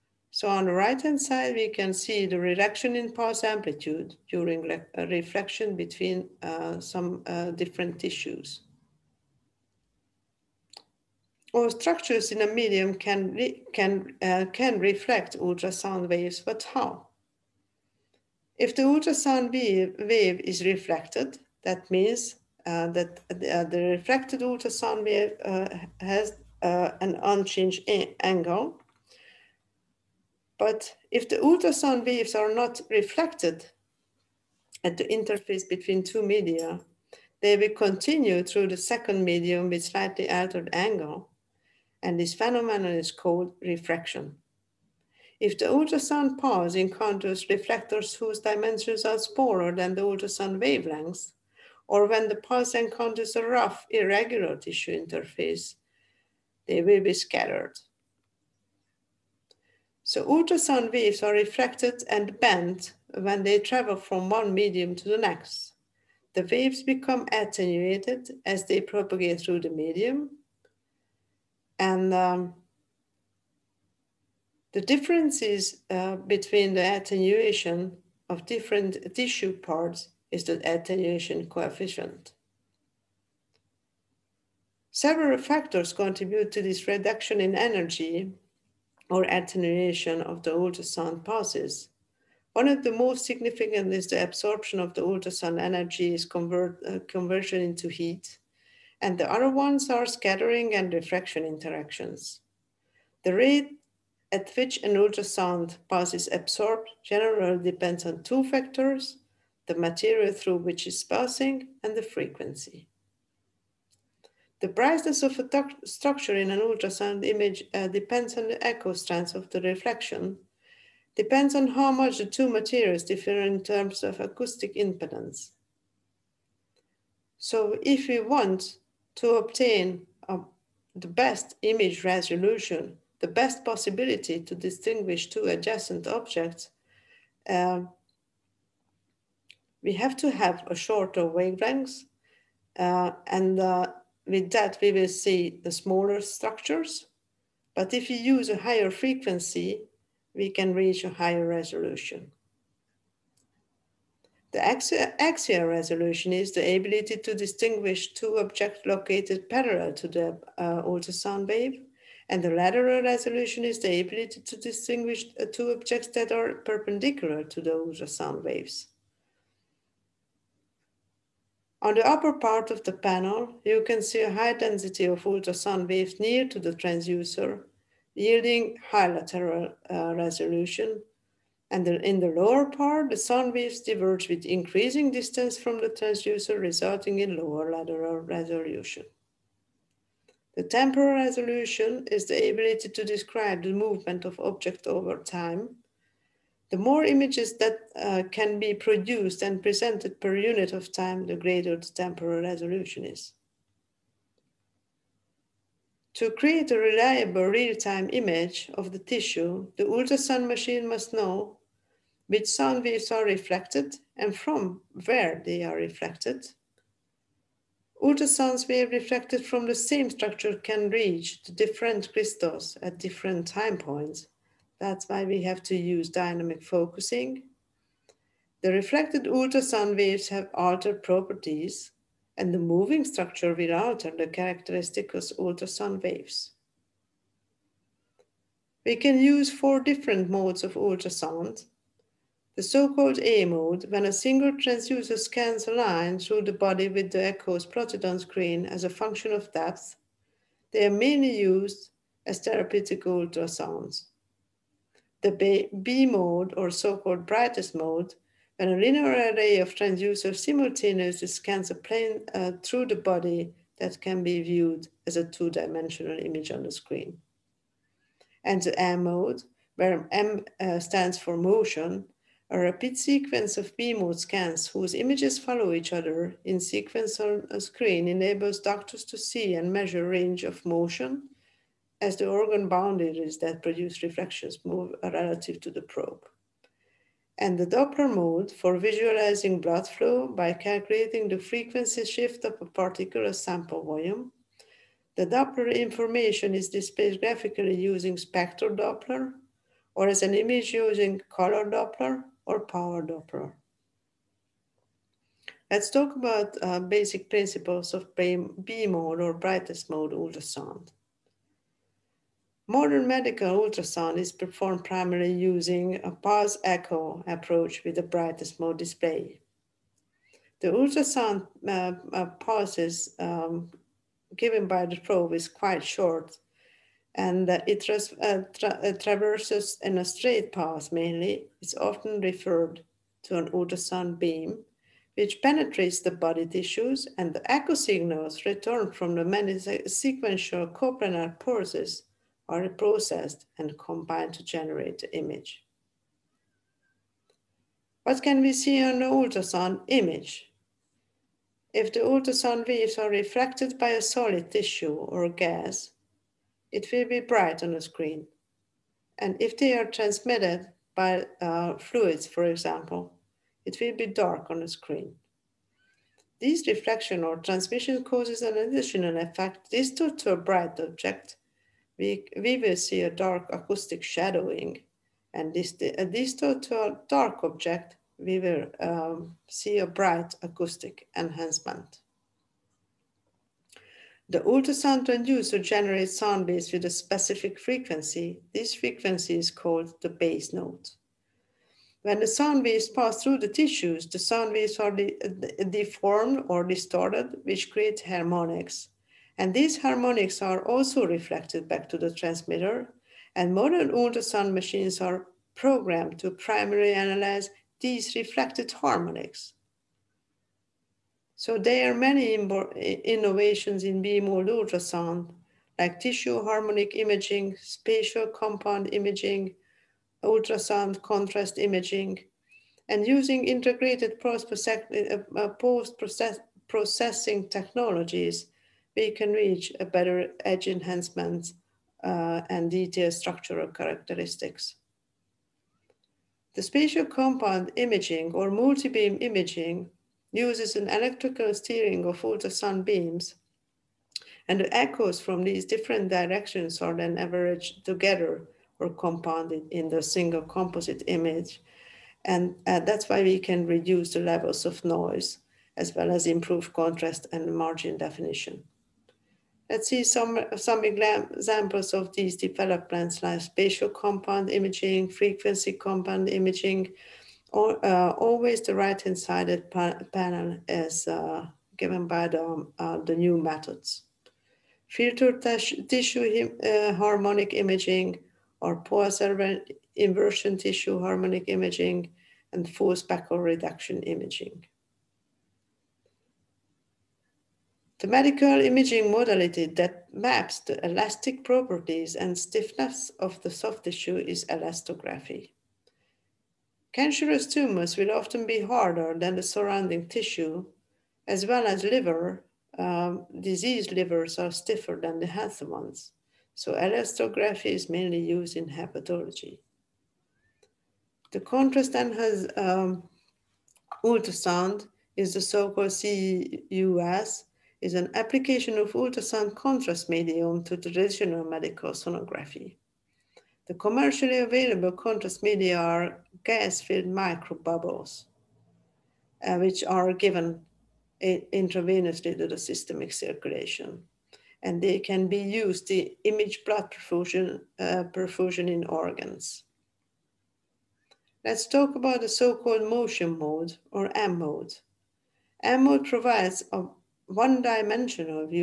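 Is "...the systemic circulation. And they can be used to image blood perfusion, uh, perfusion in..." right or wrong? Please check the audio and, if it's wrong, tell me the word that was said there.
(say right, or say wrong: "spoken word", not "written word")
right.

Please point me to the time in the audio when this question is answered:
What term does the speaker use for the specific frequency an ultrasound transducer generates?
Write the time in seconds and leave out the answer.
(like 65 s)
390 s.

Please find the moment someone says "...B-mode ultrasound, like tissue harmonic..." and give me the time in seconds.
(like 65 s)
414 s.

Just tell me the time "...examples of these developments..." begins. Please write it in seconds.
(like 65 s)
460 s.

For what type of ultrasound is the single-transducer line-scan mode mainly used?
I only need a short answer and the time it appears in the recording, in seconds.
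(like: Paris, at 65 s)
therapeutic ultrasounds, at 252 s.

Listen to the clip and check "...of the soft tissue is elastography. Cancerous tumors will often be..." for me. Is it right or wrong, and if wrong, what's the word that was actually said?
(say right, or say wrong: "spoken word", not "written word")
right.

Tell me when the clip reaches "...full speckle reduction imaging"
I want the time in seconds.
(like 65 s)
482 s.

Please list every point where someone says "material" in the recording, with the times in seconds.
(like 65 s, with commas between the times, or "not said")
109 s, 122 s.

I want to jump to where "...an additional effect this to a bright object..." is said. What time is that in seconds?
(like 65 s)
368 s.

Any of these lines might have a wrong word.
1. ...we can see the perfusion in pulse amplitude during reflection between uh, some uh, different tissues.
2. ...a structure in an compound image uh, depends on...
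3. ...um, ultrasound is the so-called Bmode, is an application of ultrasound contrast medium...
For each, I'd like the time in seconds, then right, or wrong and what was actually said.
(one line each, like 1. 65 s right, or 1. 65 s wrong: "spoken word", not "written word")
1. 1 s wrong: "reduction", not "perfusion"
2. 115 s wrong: "ultrasound", not "compound"
3. 512 s wrong: "CEUS", not "Bmode".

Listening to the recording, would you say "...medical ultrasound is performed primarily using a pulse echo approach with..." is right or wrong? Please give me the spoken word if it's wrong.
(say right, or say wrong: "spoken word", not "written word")
right.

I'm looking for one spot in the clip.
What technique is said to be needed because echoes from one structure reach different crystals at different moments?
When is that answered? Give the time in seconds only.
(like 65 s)
226 s.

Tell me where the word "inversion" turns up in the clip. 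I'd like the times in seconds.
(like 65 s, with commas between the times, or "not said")
479 s.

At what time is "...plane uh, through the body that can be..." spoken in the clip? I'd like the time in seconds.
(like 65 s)
261 s.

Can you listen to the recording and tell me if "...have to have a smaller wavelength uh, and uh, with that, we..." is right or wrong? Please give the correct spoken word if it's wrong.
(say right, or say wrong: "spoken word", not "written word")
wrong: "shorter", not "smaller".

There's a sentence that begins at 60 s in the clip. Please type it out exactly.
So ultrasound waves are refracted and bent when they travel from one medium to the next.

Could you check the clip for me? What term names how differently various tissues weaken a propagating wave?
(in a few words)
attenuation coefficient.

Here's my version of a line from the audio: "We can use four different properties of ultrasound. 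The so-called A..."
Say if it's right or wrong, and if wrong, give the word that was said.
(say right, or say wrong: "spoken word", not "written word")
wrong: "modes", not "properties".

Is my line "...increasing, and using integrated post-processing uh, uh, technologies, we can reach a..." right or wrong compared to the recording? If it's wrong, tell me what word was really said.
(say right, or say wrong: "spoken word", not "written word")
wrong: "imaging", not "increasing".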